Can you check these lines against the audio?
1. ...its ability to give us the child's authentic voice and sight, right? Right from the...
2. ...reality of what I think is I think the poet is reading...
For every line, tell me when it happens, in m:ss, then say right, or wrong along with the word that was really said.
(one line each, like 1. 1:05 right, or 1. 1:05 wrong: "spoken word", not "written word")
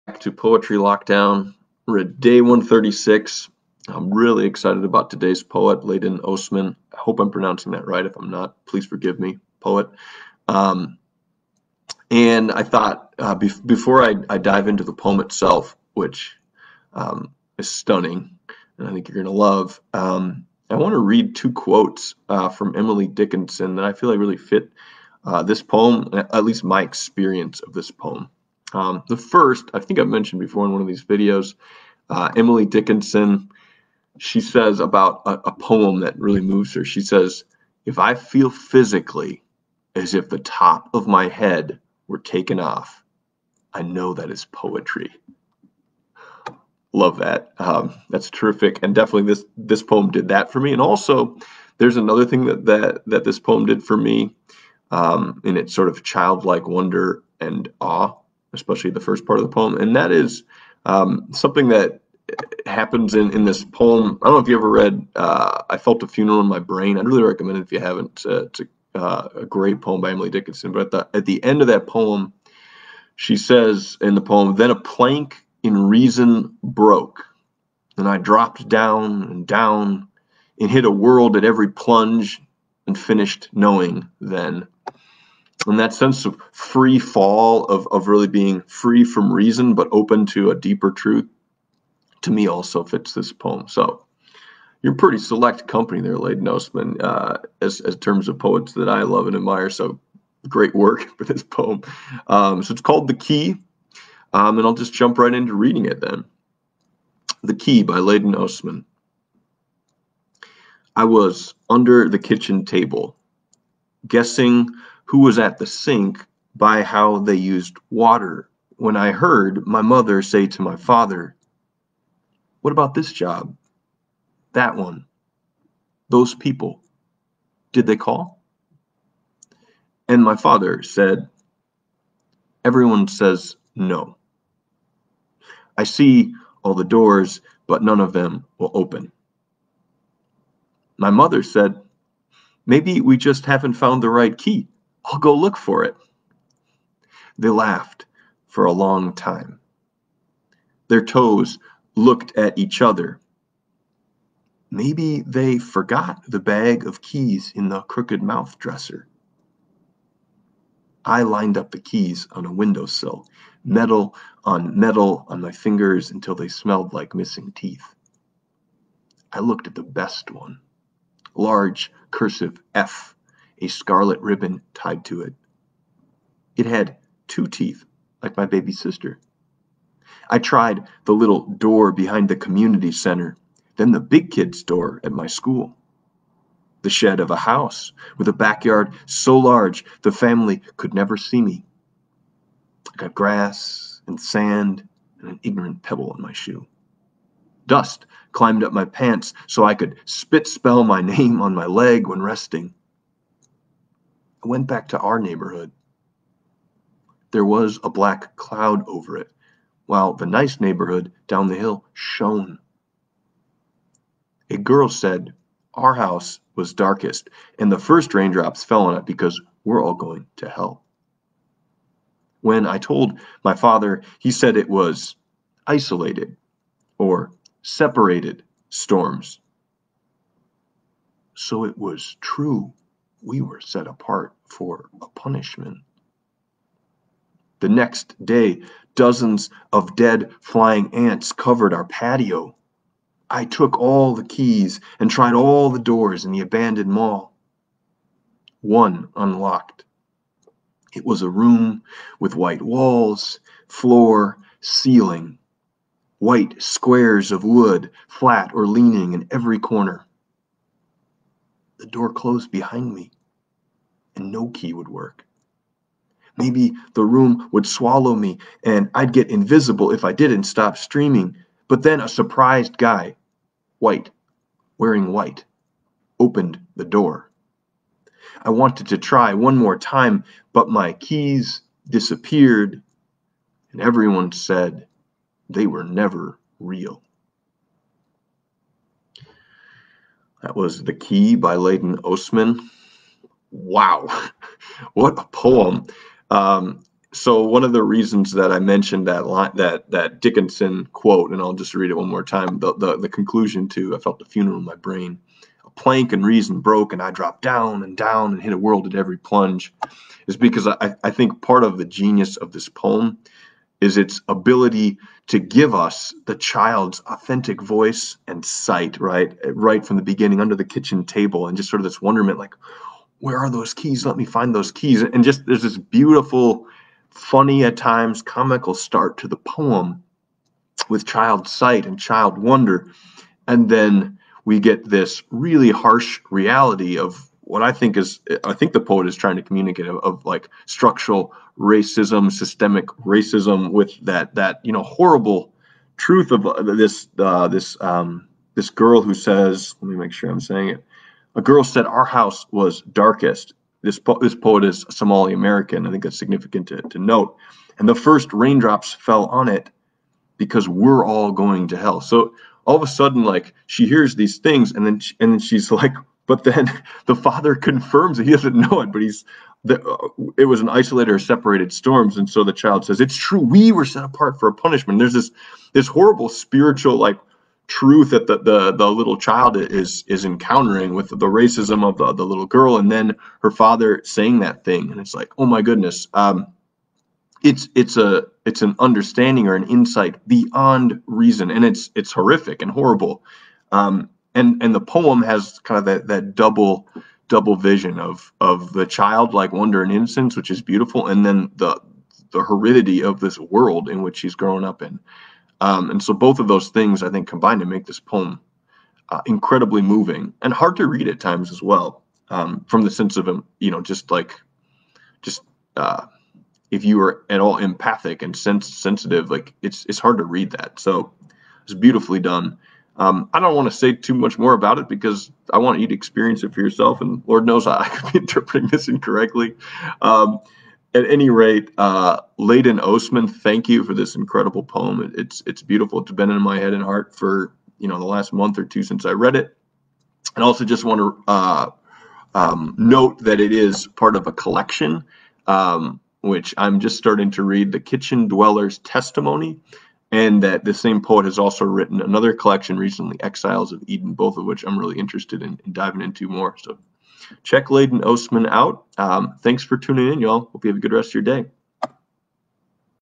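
1. 5:13 right
2. 5:36 wrong: "trying", not "reading".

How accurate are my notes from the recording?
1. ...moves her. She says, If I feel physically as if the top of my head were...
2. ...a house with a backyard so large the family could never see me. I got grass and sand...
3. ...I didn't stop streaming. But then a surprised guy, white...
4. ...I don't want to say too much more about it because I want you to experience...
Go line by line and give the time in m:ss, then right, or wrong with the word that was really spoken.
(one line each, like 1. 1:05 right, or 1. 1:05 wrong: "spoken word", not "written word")
1. 0:36 right
2. 3:07 right
3. 4:30 right
4. 7:03 right.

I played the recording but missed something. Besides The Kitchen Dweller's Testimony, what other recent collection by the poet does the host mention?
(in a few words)
Exiles of Eden.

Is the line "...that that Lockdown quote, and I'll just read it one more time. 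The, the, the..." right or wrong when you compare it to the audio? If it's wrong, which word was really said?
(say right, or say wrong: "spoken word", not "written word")
wrong: "Dickinson", not "Lockdown".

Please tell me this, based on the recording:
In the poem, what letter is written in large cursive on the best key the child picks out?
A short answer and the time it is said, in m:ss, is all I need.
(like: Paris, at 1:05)
F, at 2:52.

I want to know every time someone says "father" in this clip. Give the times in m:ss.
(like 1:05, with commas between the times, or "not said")
2:00, 2:10, 3:43, 6:07, 6:23.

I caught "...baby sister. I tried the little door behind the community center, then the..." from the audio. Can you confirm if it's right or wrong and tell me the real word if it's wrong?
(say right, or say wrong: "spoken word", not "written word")
right.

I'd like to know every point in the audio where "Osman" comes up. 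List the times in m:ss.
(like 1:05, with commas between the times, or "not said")
0:06, 1:36, 1:48, 4:52, 7:12, 7:38.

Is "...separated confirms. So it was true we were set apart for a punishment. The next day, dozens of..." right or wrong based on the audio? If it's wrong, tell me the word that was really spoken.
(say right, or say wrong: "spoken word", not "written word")
wrong: "storms", not "confirms".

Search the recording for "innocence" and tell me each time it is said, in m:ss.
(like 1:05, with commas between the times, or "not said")
6:39.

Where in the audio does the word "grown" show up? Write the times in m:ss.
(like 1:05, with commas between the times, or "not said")
6:44.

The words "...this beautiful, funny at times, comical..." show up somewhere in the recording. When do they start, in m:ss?
5:25.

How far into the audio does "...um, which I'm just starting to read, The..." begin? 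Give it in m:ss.
7:25.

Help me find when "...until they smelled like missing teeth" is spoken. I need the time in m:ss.
2:46.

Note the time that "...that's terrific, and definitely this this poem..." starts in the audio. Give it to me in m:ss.
0:48.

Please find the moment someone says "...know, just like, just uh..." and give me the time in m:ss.
6:53.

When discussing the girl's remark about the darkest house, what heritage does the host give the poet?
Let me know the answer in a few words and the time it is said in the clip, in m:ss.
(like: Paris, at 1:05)
Somali American, at 5:54.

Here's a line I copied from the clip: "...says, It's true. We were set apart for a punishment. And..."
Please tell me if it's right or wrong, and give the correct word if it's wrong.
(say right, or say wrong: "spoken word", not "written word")
right.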